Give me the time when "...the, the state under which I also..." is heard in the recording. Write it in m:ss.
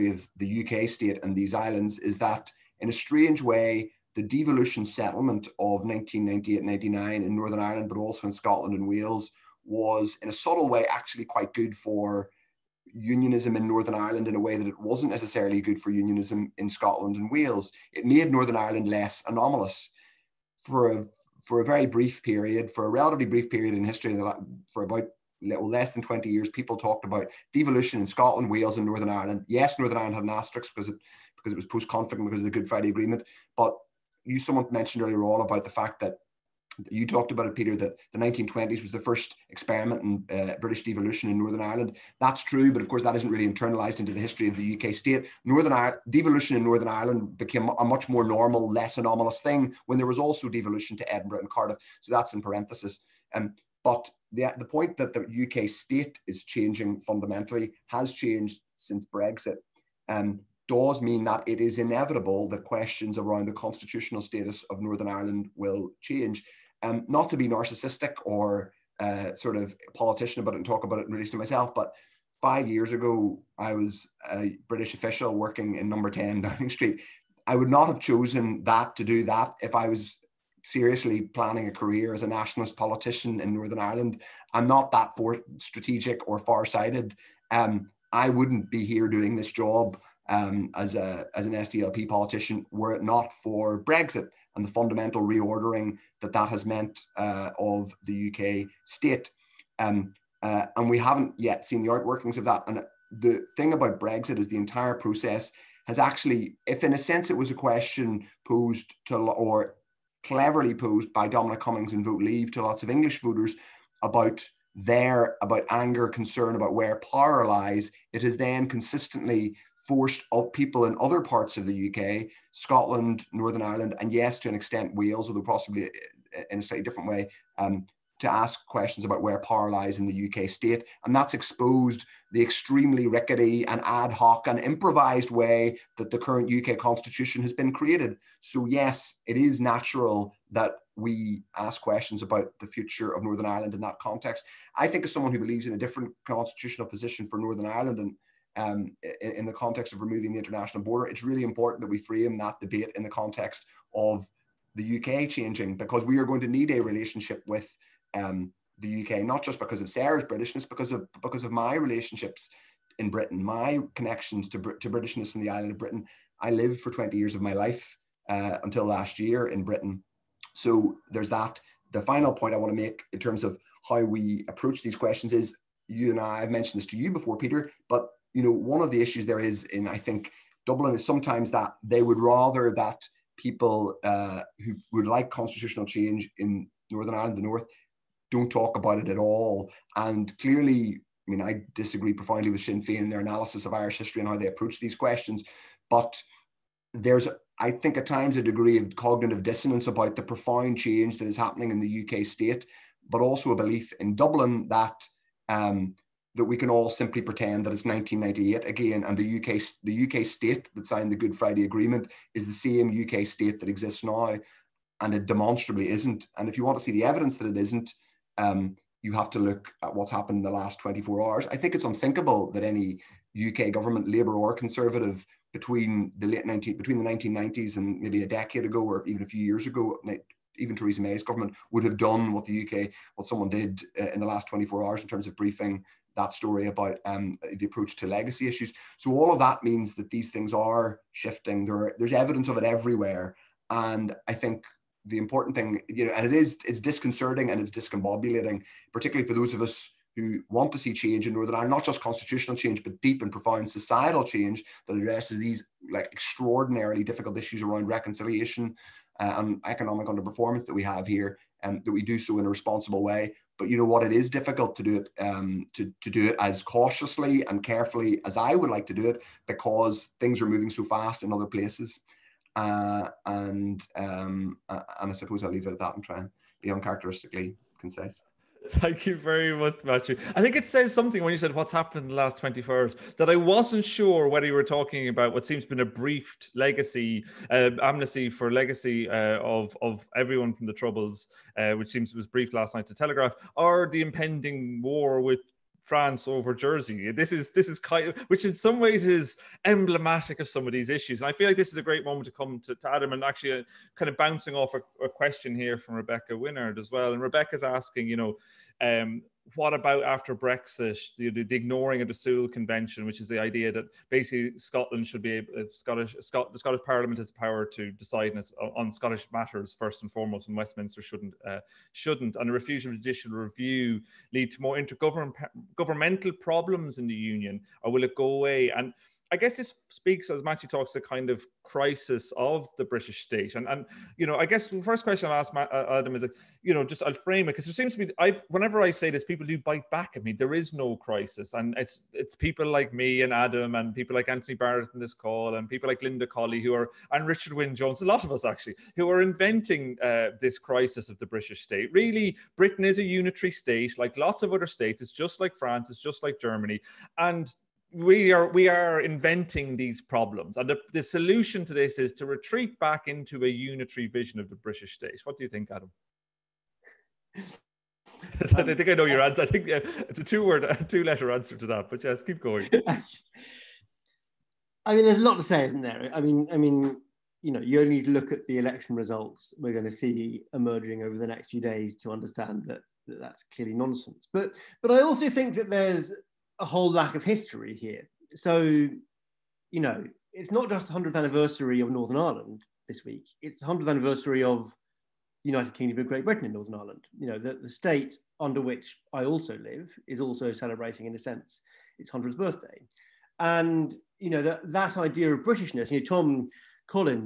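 6:37.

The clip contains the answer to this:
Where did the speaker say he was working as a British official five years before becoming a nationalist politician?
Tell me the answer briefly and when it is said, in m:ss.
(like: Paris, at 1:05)
Number 10 Downing Street, at 1:15.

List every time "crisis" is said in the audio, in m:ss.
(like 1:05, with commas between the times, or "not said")
5:31, 5:40, 5:50.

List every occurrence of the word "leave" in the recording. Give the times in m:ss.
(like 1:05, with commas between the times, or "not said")
1:52, 4:35.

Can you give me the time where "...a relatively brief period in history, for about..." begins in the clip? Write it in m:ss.
0:22.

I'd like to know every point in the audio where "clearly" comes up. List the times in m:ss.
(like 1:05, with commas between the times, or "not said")
3:10, 6:23.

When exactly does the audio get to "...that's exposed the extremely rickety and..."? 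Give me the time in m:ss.
2:11.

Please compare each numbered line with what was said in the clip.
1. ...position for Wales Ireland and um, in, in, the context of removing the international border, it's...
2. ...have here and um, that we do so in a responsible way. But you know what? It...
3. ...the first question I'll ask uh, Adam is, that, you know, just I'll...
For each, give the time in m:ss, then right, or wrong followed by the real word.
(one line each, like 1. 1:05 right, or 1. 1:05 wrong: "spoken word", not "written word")
1. 2:26 wrong: "Northern", not "Wales"
2. 4:20 right
3. 5:34 right.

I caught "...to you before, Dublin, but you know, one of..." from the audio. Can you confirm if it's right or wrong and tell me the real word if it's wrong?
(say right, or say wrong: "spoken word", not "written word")
wrong: "Peter", not "Dublin".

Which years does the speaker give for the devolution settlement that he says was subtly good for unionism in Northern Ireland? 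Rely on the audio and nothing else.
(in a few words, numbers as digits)
1998-99.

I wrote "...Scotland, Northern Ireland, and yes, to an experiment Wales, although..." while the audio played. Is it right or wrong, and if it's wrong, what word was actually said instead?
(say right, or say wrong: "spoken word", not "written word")
wrong: "extent", not "experiment".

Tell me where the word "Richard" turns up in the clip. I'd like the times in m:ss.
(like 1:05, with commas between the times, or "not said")
5:47.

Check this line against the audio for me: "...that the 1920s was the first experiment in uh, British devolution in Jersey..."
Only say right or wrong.
wrong.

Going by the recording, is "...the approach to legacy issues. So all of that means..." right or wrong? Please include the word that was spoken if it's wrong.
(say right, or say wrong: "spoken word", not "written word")
right.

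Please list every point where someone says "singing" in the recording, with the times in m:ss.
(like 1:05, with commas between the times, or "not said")
not said.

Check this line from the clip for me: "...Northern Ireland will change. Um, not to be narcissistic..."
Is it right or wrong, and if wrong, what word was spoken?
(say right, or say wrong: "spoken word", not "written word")
right.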